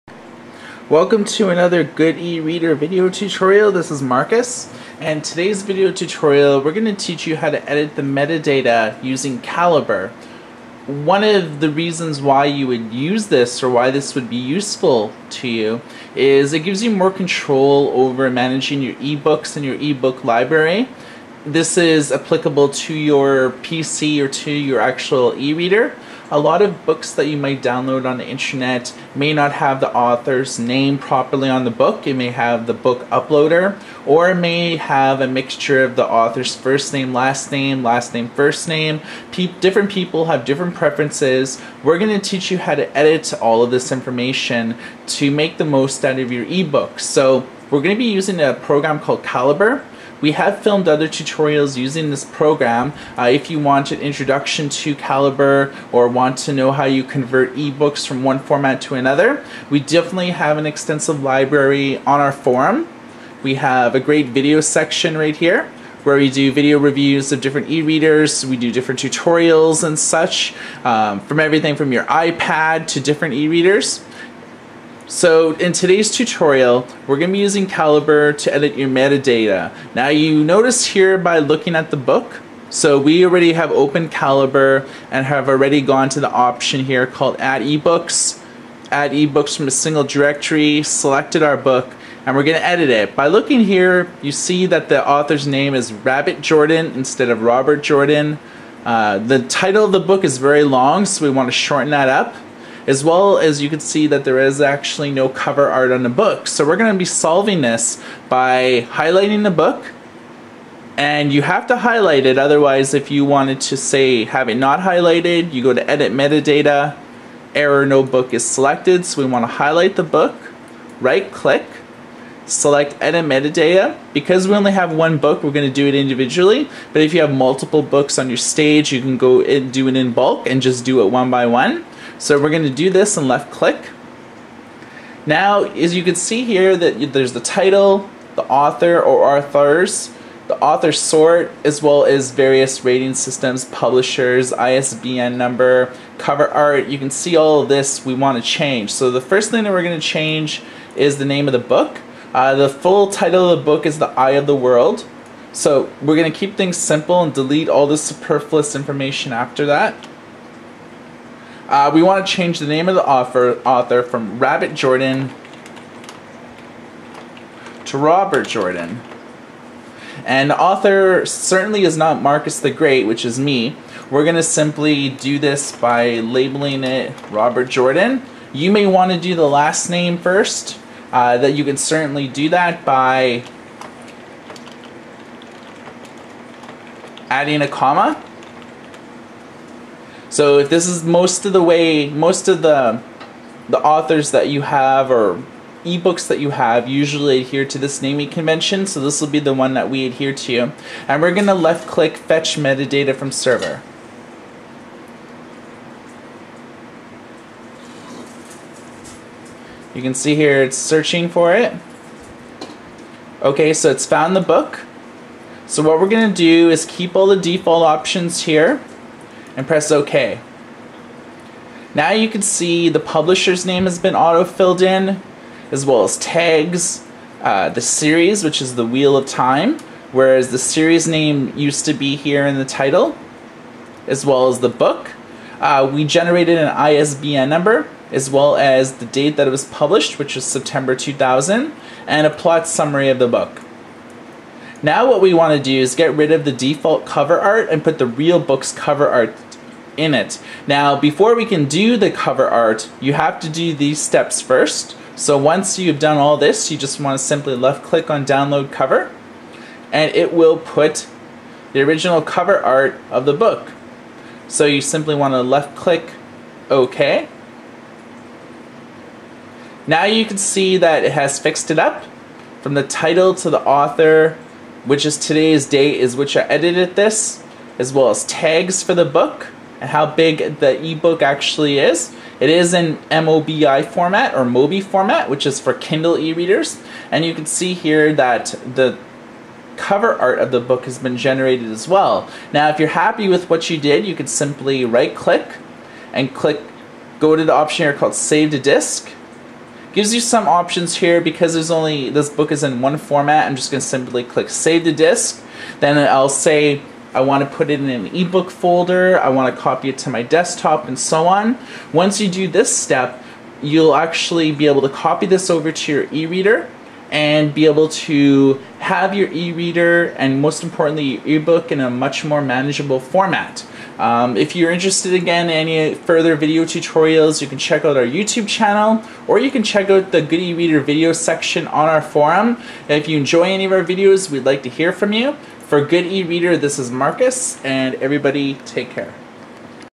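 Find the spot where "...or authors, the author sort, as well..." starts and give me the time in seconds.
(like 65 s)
139 s.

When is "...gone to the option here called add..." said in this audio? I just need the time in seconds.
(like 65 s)
85 s.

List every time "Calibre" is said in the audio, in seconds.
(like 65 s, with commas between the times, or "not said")
9 s, 49 s, 54 s, 77 s, 84 s.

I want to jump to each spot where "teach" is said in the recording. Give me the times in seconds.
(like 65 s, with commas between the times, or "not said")
6 s, 42 s.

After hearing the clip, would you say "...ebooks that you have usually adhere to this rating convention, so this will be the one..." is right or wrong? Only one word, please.
wrong.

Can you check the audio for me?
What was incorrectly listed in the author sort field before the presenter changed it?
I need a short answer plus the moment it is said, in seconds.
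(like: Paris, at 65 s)
Marcus the Great, at 172 s.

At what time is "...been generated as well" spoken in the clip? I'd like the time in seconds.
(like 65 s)
290 s.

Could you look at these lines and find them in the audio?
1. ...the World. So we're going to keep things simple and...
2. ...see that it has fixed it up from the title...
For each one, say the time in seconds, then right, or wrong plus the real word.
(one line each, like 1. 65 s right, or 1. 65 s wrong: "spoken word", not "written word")
1. 154 s right
2. 270 s right.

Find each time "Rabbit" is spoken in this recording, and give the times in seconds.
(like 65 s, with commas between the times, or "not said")
95 s, 164 s.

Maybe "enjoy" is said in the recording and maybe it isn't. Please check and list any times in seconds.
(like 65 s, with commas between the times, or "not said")
333 s.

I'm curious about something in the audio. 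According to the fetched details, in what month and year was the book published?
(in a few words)
September 2000.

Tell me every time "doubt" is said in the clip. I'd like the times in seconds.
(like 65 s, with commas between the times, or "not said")
not said.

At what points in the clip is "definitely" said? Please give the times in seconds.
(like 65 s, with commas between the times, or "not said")
59 s.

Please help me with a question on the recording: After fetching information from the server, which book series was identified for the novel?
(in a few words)
Wheel of Time.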